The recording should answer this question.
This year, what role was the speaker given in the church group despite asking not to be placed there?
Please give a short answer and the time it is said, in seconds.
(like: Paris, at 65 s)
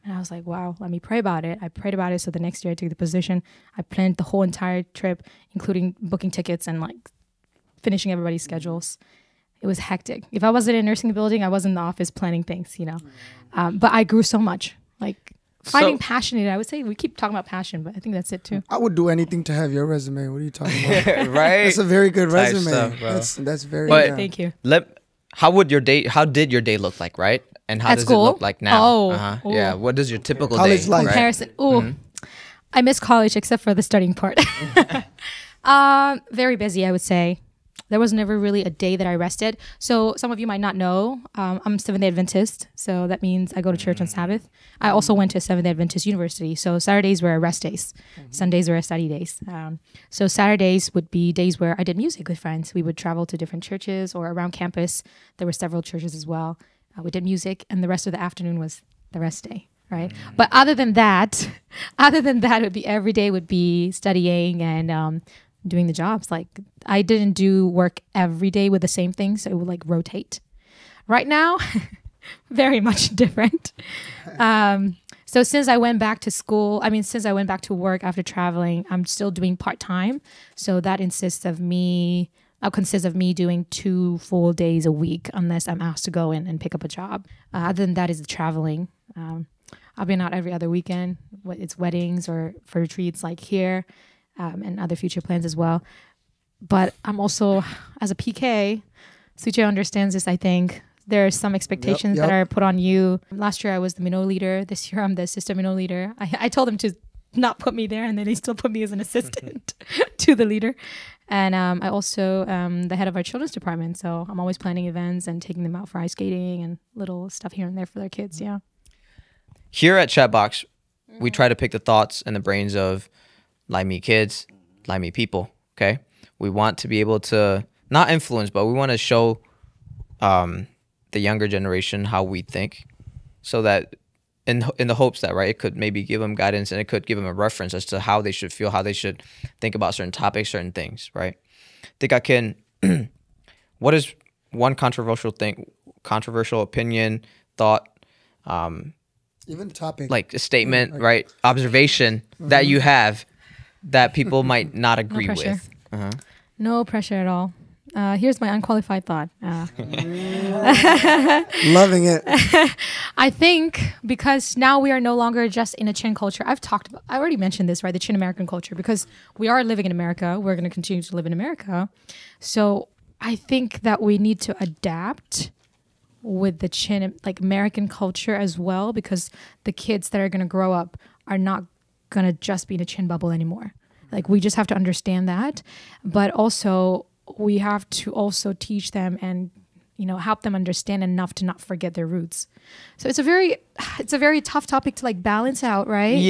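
assistant mino leader, at 105 s.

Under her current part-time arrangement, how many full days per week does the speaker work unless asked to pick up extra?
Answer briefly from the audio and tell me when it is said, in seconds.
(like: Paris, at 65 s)
2, at 83 s.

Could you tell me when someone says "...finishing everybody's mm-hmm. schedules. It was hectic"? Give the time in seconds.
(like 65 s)
7 s.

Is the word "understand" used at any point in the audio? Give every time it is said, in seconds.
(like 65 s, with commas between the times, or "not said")
99 s, 184 s, 190 s.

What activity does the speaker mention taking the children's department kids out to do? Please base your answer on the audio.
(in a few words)
ice skating.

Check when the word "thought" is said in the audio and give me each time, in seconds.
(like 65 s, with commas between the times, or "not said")
121 s, 147 s, 159 s.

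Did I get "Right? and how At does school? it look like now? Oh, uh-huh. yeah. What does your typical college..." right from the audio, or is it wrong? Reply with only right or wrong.
right.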